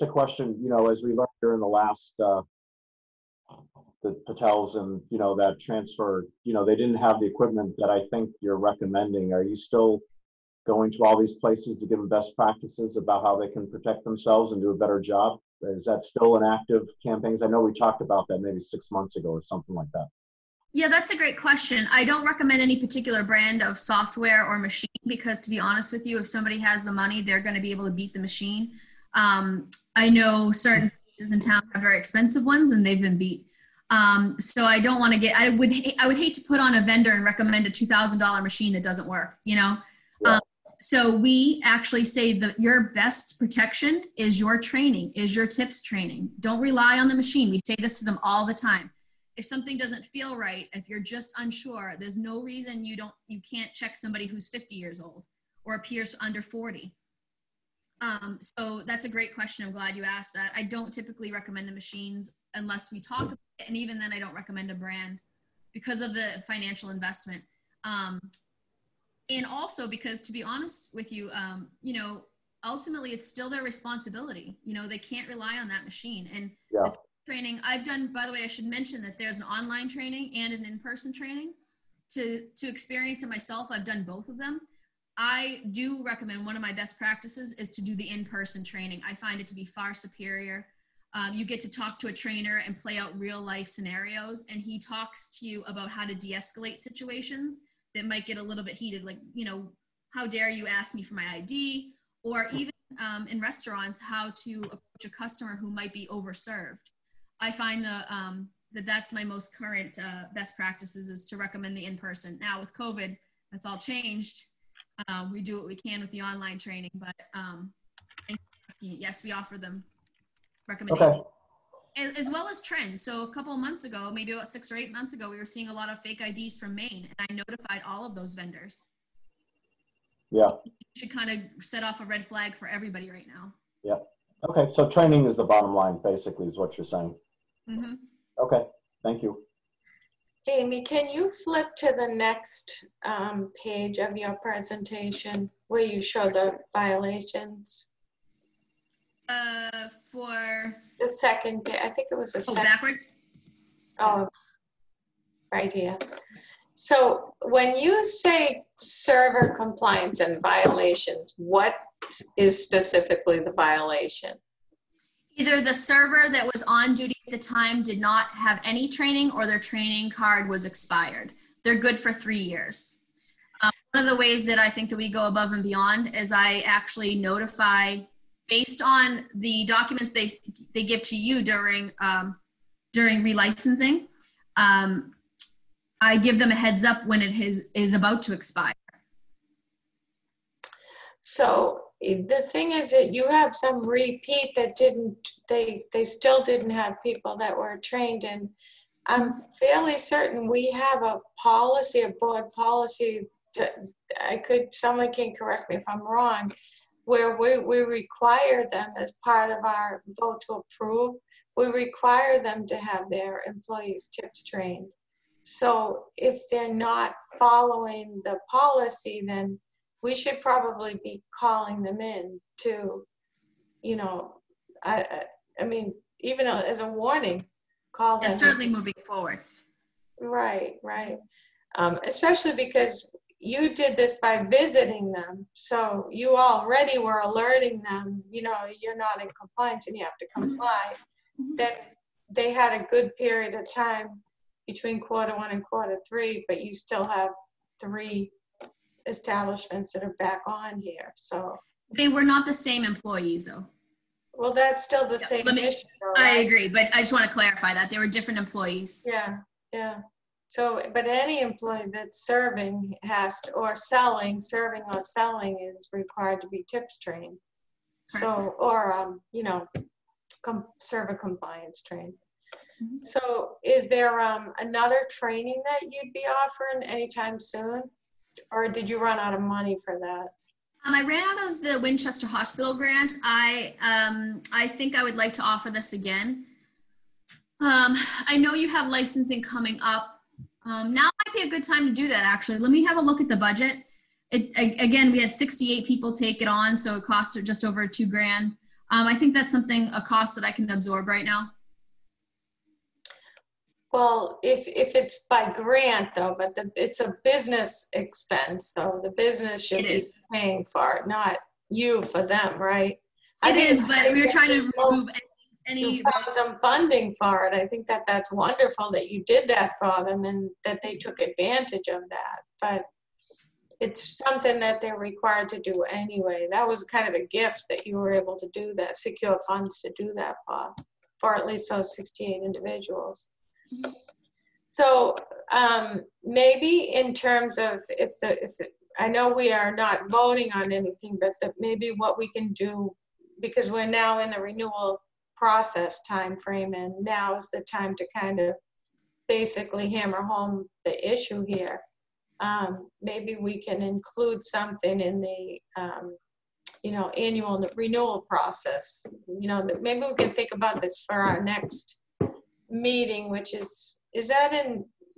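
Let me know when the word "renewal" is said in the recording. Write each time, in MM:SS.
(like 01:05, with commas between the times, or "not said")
05:44, 05:57.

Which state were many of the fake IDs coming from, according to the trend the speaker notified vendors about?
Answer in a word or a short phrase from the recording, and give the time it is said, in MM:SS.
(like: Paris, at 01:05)
Maine, at 02:06.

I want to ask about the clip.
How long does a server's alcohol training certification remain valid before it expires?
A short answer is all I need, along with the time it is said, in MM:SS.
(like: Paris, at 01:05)
3 years, at 02:52.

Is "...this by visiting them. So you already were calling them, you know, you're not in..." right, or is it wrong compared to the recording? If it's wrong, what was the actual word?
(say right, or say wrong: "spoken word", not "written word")
wrong: "alerting", not "calling".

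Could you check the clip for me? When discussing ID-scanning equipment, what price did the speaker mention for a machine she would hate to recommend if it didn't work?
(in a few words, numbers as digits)
$2,000.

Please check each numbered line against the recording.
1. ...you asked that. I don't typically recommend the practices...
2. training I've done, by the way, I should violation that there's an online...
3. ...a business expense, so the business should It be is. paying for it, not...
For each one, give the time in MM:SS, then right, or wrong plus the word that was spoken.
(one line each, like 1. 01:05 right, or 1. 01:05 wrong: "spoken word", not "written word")
1. 00:59 wrong: "machines", not "practices"
2. 01:17 wrong: "mention", not "violation"
3. 05:07 right.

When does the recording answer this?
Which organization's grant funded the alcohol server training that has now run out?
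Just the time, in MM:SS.
04:41.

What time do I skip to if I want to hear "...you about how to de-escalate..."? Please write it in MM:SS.
01:35.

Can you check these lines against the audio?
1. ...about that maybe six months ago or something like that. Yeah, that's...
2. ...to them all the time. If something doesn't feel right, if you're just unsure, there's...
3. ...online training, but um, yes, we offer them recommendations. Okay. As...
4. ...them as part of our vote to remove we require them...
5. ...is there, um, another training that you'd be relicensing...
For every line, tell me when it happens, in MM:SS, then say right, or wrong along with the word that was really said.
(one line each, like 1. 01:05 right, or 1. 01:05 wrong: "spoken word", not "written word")
1. 00:18 right
2. 00:47 right
3. 01:56 right
4. 03:28 wrong: "approve", not "remove"
5. 04:33 wrong: "offering", not "relicensing".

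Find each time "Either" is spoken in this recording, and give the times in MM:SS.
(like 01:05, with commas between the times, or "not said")
02:45.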